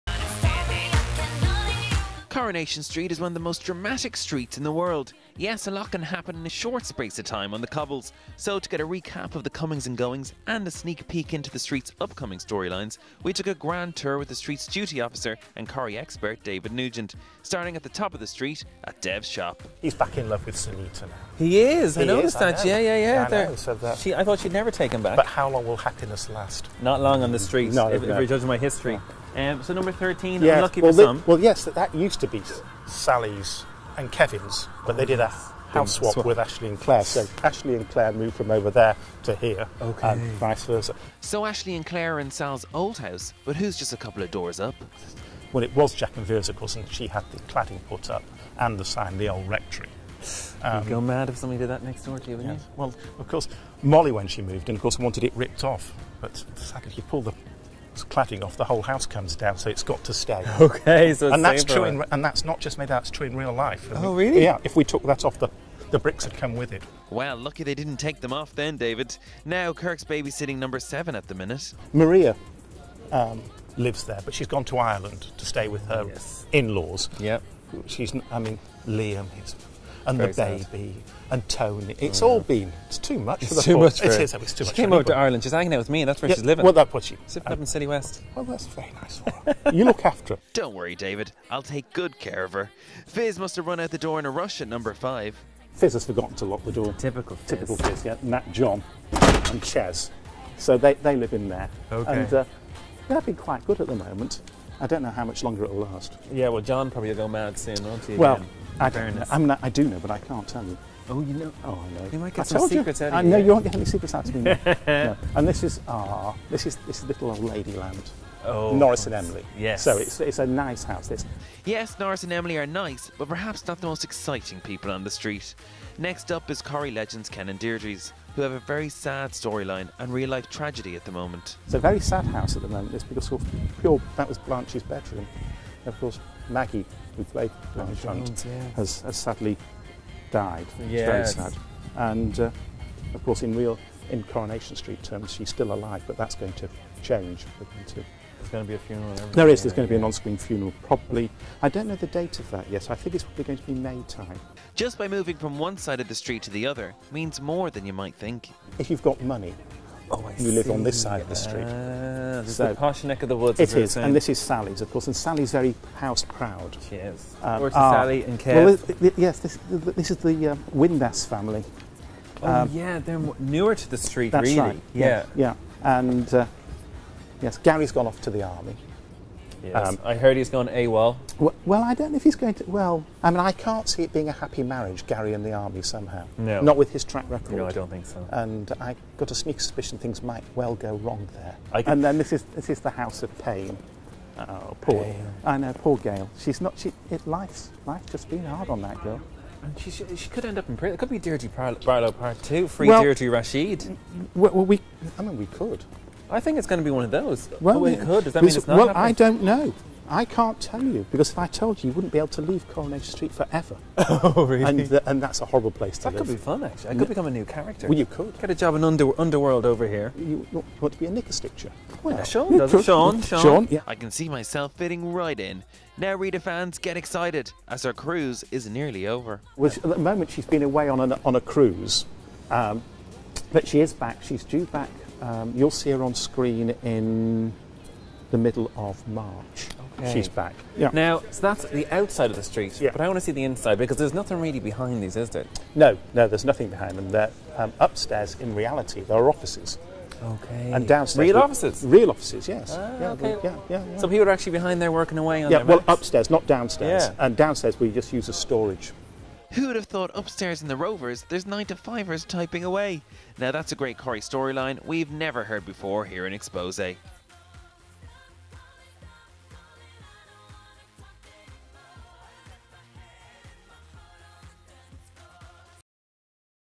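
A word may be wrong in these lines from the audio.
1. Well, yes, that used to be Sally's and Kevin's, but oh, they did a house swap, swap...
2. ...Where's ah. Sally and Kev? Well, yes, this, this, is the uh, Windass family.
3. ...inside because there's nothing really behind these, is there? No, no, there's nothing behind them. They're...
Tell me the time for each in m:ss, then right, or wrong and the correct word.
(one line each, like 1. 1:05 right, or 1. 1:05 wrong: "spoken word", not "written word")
1. 0:31 right
2. 2:47 right
3. 4:03 right.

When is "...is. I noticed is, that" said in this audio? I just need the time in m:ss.
0:21.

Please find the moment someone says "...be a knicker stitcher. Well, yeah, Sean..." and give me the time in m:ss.
3:40.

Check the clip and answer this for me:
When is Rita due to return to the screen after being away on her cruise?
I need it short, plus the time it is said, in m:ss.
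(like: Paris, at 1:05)
Middle of March, at 3:58.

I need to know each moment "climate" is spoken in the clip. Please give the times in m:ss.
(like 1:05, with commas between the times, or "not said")
not said.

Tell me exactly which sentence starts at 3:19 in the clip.
And she, she, she could end up in prison.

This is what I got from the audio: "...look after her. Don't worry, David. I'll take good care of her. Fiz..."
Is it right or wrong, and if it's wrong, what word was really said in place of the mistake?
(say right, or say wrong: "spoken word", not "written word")
right.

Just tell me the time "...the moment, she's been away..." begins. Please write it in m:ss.
3:49.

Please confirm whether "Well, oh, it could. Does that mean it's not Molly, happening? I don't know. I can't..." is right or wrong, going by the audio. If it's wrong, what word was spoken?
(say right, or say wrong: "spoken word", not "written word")
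wrong: "Well", not "Molly".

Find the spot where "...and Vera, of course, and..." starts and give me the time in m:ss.
0:46.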